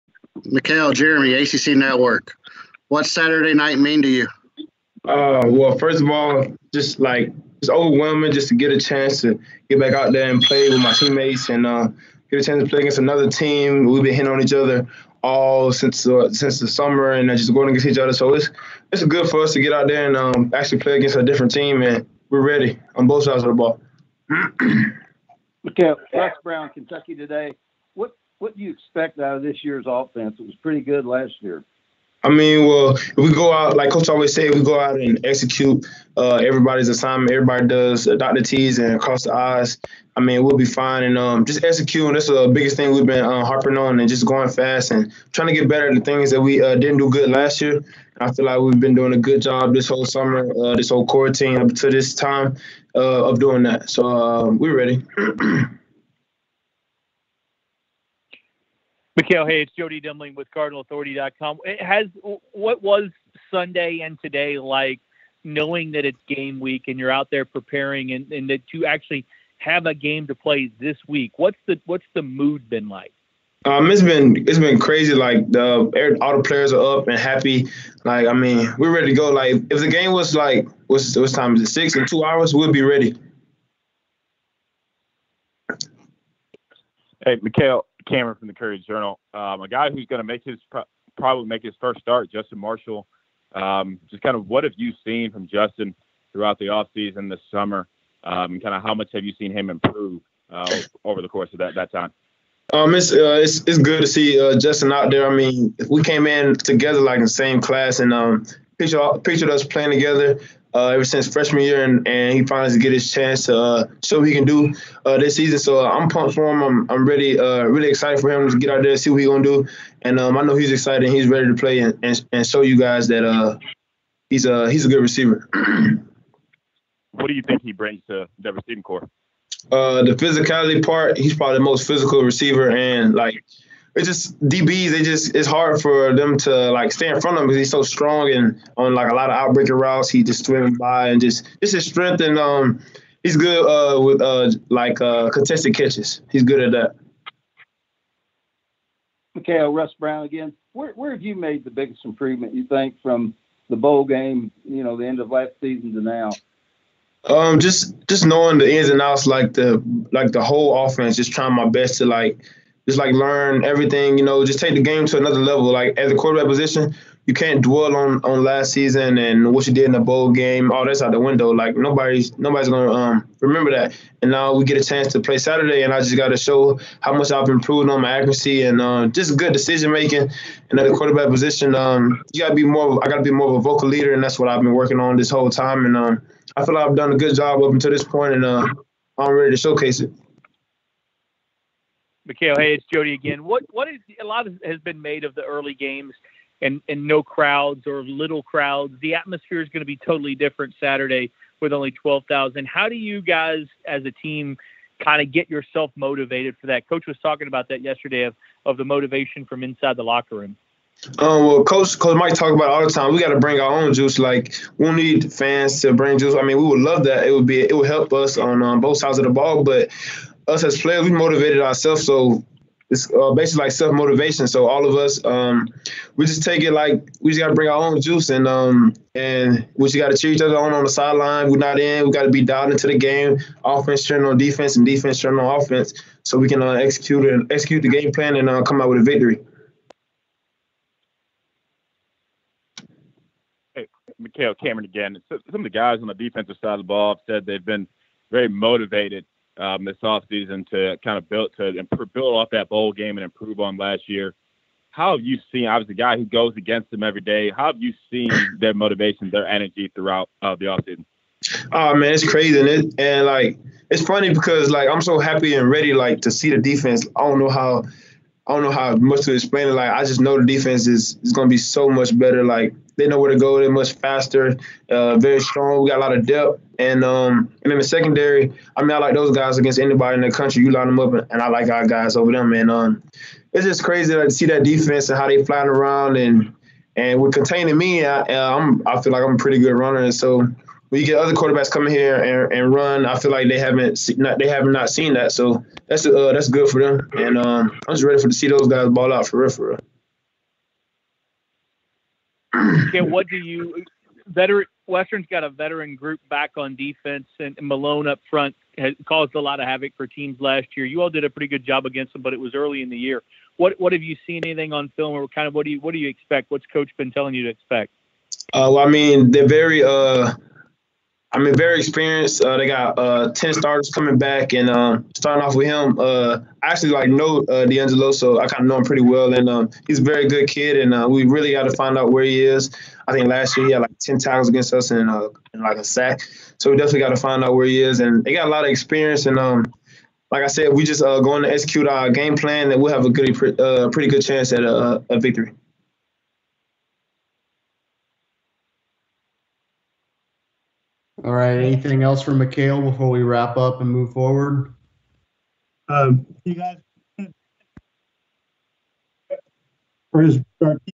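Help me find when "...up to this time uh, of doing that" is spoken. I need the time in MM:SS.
00:51.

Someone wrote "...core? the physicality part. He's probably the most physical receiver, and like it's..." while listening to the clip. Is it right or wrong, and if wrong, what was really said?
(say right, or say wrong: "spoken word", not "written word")
right.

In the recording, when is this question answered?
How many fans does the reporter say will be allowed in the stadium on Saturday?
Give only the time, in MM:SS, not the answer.
03:21.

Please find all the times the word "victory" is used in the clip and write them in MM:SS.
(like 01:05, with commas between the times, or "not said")
03:59, 05:45.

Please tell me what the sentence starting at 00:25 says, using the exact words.
okay, Russ Brown, Kentucky today what do you expect out of this year's offense?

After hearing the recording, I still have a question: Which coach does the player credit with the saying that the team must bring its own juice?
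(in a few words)
Coach Mike.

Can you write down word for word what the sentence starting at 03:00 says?
And at the quarterback position, um, you gotta be more.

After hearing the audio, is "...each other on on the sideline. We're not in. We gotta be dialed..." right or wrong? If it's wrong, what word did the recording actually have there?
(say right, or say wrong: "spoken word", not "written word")
right.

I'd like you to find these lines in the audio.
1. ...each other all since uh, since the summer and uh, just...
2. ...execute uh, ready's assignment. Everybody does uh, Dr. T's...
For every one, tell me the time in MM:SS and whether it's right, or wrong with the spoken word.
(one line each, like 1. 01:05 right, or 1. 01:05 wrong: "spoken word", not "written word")
1. 00:14 right
2. 00:35 wrong: "everybody", not "ready".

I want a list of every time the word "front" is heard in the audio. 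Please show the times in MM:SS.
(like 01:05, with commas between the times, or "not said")
02:17, 05:08.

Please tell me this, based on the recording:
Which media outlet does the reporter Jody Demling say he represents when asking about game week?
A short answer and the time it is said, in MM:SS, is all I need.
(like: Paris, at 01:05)
CardinalAuthority.com, at 01:00.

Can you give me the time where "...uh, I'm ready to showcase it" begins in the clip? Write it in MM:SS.
03:08.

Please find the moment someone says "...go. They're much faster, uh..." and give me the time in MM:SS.
04:33.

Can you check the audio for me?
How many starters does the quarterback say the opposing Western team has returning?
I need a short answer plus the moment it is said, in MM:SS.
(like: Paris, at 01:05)
10, at 05:23.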